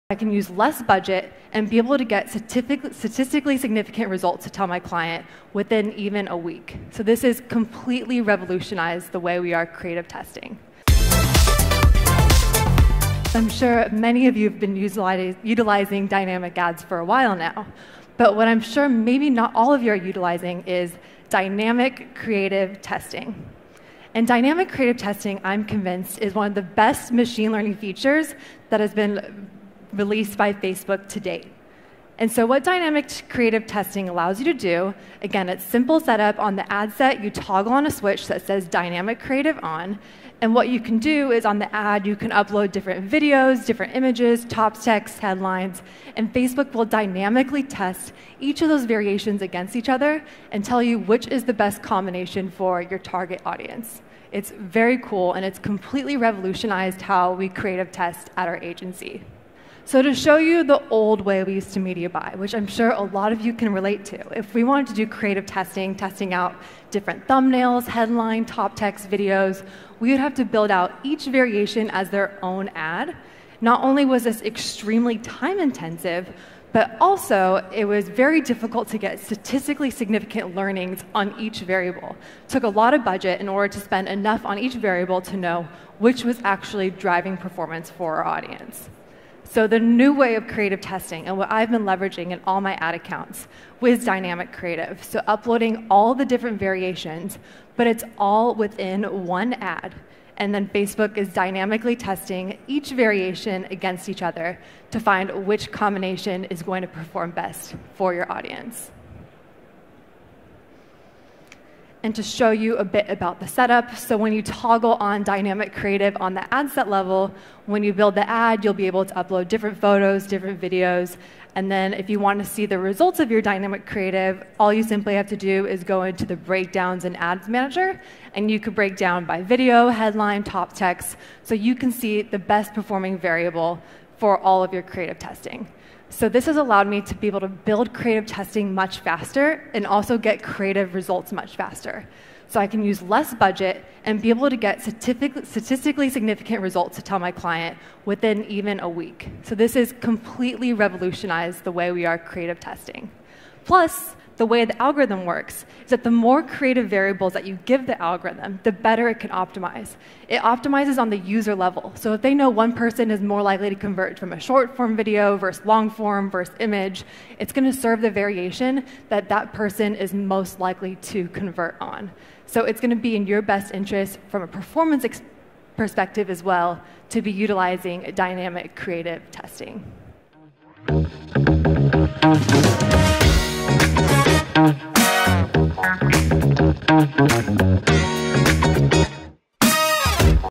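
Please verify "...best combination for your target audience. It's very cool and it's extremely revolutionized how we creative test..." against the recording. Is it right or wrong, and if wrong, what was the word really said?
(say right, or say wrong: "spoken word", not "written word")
wrong: "completely", not "extremely".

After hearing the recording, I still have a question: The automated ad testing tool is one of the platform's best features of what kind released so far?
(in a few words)
machine learning.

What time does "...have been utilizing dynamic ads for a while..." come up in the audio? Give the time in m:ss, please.
0:14.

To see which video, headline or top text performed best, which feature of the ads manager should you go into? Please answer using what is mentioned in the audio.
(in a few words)
breakdowns.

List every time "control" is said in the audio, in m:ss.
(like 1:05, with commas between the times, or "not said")
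not said.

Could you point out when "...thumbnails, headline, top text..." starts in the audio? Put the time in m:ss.
1:07.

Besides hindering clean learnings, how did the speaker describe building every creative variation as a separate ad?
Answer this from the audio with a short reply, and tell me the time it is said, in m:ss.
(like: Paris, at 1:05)
extremely time intensive, at 1:14.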